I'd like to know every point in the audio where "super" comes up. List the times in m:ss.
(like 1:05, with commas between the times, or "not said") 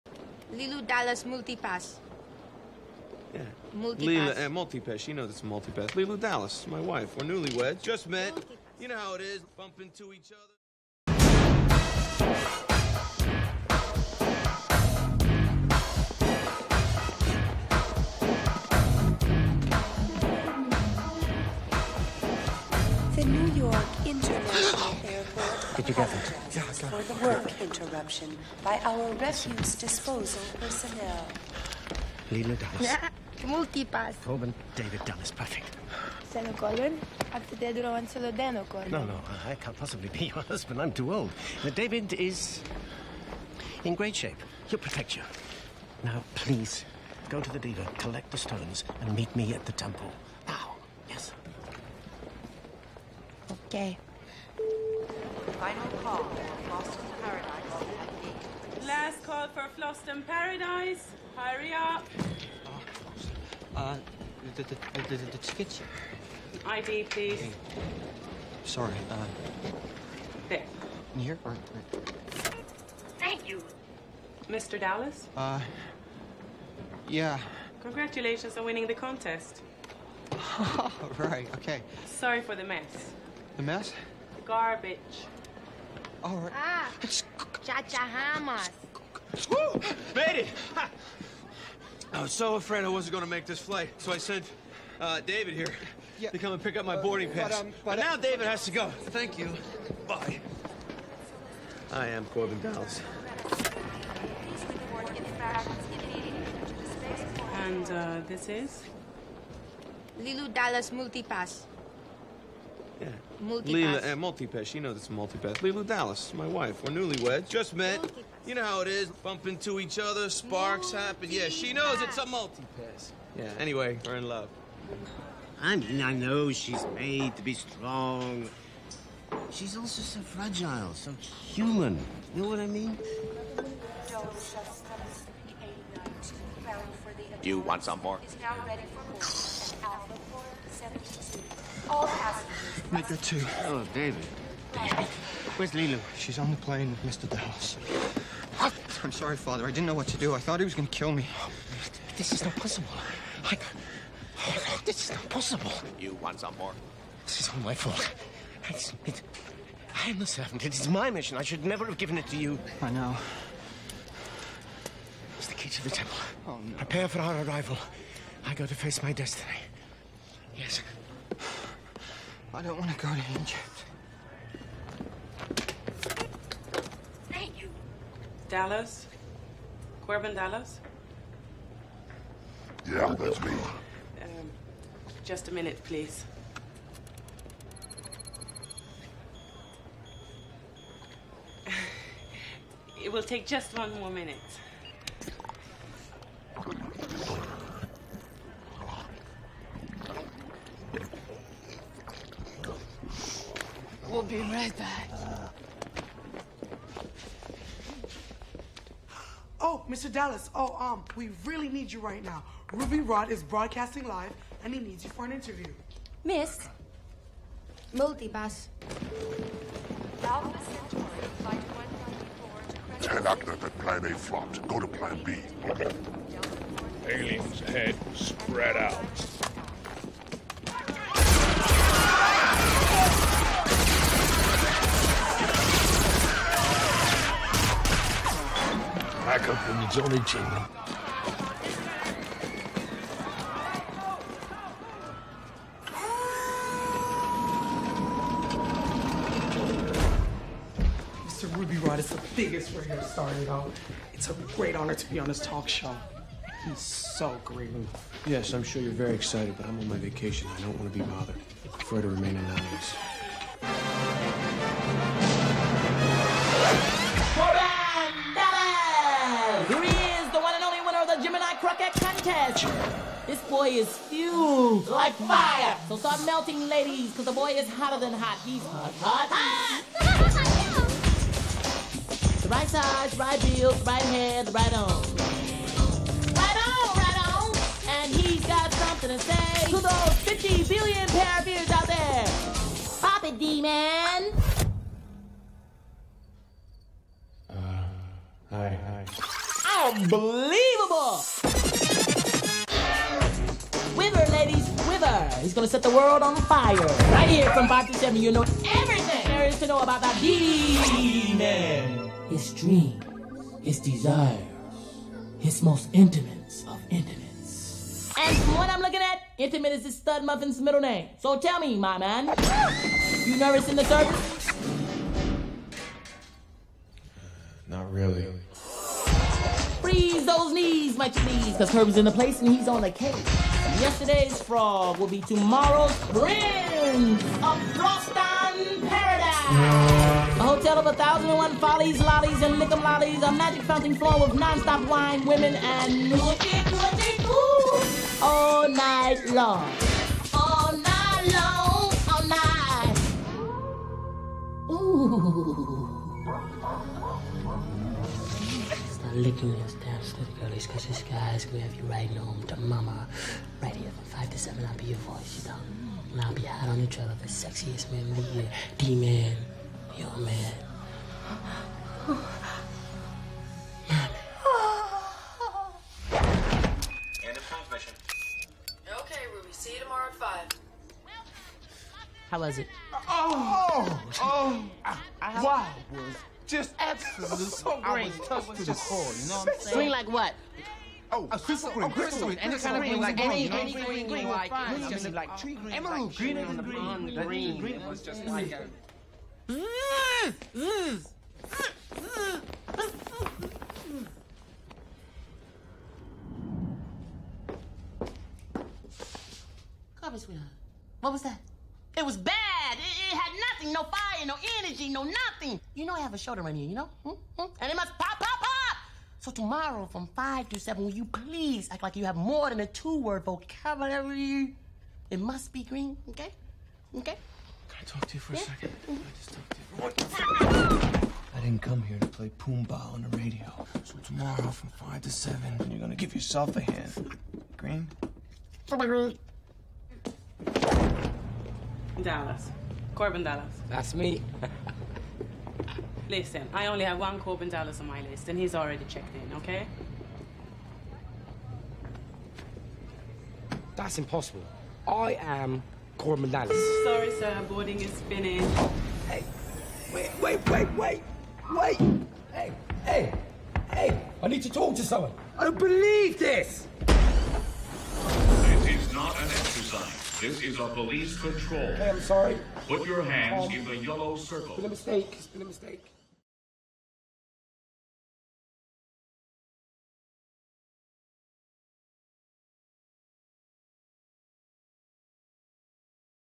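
6:31.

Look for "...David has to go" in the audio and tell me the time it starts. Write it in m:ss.
1:38.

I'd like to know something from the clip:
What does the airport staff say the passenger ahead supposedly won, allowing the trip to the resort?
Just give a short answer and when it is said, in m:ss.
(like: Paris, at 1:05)
The contest, at 1:18.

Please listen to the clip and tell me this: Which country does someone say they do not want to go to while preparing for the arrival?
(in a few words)
Egypt.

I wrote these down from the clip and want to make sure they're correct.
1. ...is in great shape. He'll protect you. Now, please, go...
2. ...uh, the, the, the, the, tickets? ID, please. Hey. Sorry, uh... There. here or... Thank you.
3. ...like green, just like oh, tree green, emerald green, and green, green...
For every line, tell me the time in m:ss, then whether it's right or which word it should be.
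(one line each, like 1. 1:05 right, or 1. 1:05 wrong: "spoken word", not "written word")
1. 0:42 right
2. 1:03 right
3. 6:34 right.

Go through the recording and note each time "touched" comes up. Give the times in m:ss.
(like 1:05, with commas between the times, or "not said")
6:28.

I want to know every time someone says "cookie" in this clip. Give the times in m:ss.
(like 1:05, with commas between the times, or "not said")
not said.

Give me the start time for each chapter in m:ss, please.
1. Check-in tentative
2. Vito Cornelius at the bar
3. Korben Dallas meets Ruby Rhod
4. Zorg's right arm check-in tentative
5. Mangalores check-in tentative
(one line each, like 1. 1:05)
1. 0:58
2. 2:05
3. 4:10
4. 7:20
5. 2:54.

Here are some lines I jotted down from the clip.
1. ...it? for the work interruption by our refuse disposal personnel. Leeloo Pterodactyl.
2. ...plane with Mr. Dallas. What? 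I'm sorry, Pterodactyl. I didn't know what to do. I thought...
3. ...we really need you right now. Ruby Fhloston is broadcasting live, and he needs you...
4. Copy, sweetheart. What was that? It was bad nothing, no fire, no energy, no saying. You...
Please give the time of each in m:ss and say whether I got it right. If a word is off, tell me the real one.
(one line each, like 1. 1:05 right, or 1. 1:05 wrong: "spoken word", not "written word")
1. 0:26 wrong: "Dallas", not "Pterodactyl"
2. 2:26 wrong: "Father", not "Pterodactyl"
3. 3:31 wrong: "Rhod", not "Fhloston"
4. 6:50 wrong: "nothing", not "saying".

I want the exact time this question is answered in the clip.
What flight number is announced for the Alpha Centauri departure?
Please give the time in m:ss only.
3:41.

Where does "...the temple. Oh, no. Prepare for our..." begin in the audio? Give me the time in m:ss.
2:45.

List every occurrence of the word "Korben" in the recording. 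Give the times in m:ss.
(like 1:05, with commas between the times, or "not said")
1:42, 3:00, 7:22, 7:27, 7:35.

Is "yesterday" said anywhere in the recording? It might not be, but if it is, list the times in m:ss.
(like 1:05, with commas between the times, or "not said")
5:33.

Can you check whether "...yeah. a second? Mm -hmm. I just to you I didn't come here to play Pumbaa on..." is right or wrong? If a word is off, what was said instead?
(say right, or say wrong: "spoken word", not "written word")
right.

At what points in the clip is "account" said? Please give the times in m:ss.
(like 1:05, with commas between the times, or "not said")
not said.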